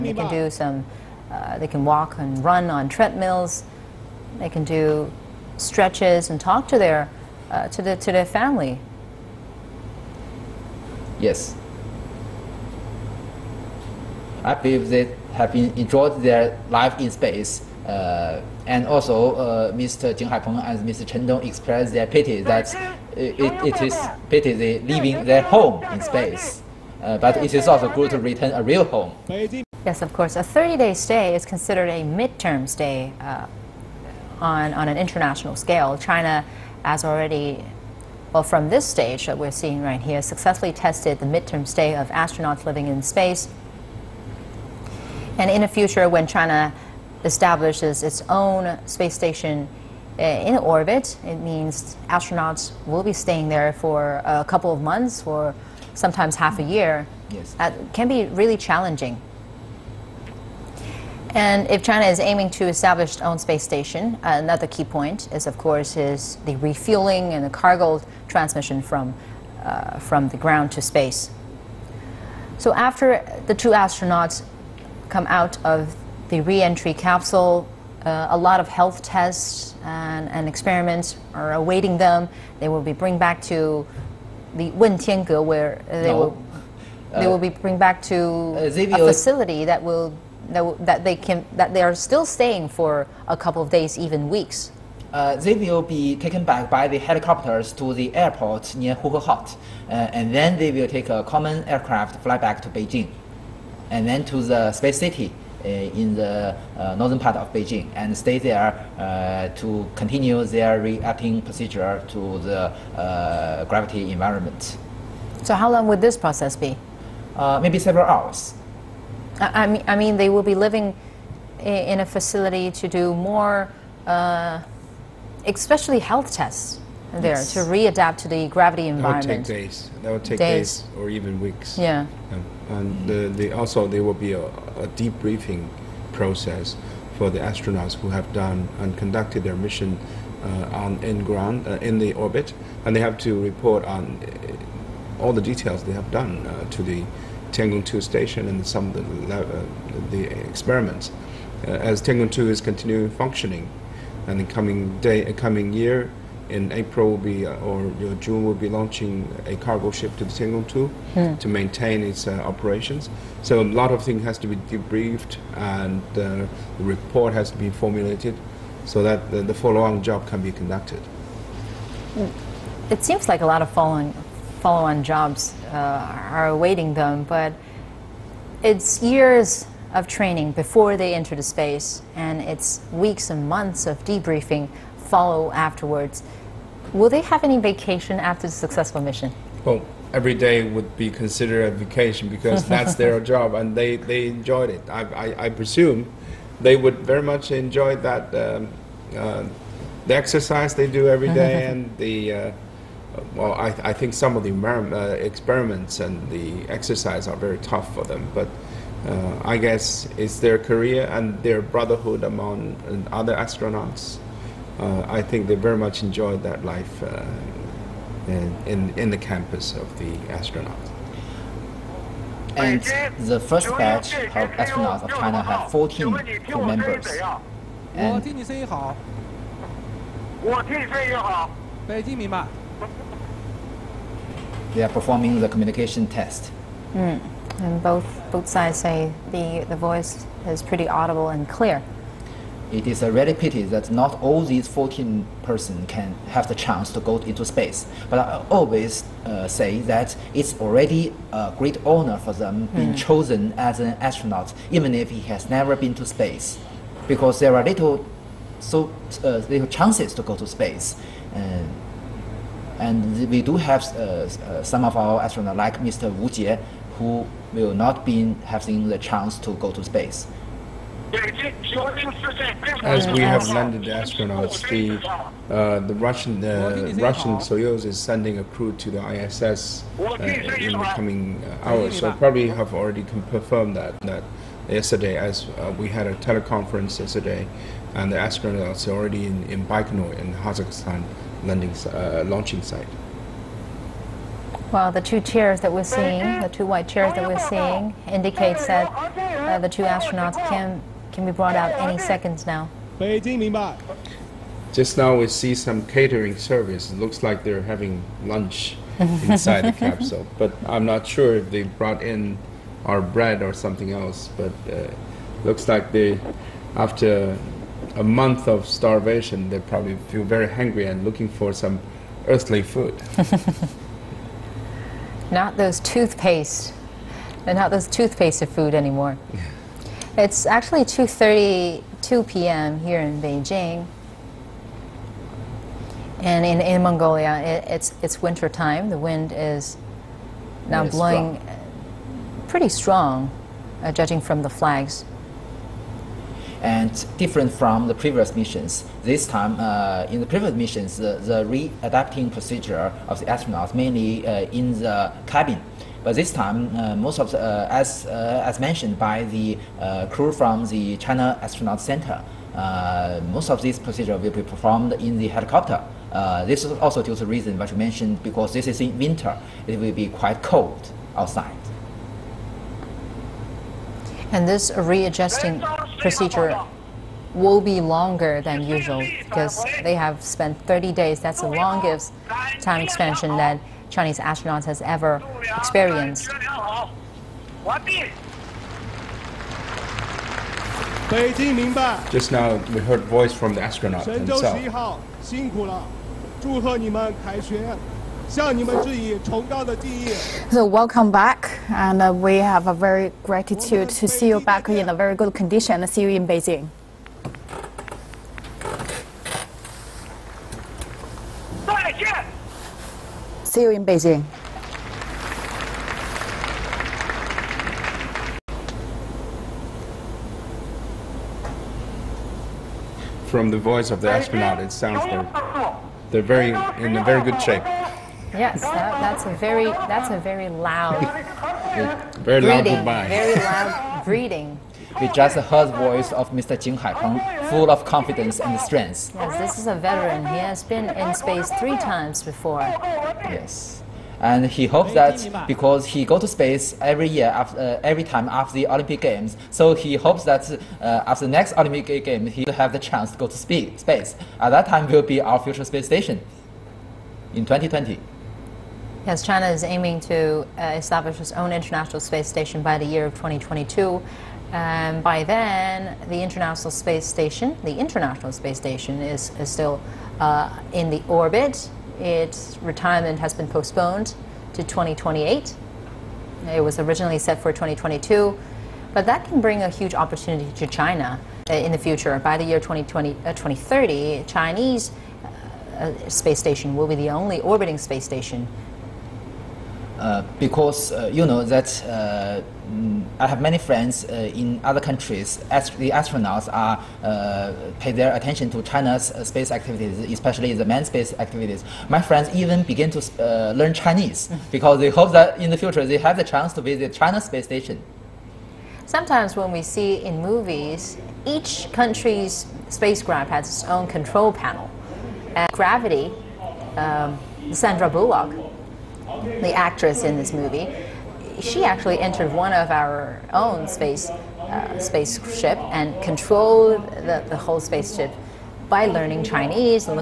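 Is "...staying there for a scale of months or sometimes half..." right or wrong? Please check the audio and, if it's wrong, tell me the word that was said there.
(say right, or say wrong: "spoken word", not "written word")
wrong: "couple", not "scale".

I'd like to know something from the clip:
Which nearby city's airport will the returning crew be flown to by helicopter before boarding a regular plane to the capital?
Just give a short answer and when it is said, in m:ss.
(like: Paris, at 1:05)
Huhhot, at 1:38.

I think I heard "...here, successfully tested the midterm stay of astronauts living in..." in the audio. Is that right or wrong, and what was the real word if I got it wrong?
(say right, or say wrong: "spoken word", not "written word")
right.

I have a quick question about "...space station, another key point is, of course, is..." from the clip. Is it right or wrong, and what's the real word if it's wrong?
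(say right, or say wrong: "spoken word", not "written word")
right.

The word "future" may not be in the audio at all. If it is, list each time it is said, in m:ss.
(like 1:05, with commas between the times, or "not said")
0:45, 7:35, 8:01, 8:25.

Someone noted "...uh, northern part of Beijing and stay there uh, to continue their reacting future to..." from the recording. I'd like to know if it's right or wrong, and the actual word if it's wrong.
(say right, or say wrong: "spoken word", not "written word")
wrong: "procedure", not "future".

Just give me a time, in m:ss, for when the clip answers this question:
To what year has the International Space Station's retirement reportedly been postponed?
7:54.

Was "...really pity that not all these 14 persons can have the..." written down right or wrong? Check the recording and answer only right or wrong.
right.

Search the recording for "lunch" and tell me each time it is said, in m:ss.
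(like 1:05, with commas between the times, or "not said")
5:08.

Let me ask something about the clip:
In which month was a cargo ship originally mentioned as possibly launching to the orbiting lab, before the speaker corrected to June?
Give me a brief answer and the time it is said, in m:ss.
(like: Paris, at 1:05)
April, at 2:36.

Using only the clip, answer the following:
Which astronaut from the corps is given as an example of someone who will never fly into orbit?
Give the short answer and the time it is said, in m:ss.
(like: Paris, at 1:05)
Wu Jie, at 4:25.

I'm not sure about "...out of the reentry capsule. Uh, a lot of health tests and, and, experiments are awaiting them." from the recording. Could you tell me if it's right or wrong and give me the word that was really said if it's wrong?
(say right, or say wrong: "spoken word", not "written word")
right.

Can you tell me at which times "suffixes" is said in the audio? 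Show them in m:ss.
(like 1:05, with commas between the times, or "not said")
not said.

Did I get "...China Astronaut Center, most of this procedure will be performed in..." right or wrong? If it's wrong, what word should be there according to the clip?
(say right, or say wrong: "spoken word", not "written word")
right.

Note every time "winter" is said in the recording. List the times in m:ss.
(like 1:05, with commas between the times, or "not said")
5:38, 6:08.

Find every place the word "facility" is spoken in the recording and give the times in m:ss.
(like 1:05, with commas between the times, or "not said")
1:28, 2:02.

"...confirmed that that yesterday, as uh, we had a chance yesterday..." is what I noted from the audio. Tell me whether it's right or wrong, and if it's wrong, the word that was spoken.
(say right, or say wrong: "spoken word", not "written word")
wrong: "teleconference", not "chance".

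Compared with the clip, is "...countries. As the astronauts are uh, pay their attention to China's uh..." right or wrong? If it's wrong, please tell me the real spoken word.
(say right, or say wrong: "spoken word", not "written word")
right.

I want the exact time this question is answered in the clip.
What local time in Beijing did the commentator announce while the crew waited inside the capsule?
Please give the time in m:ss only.
5:30.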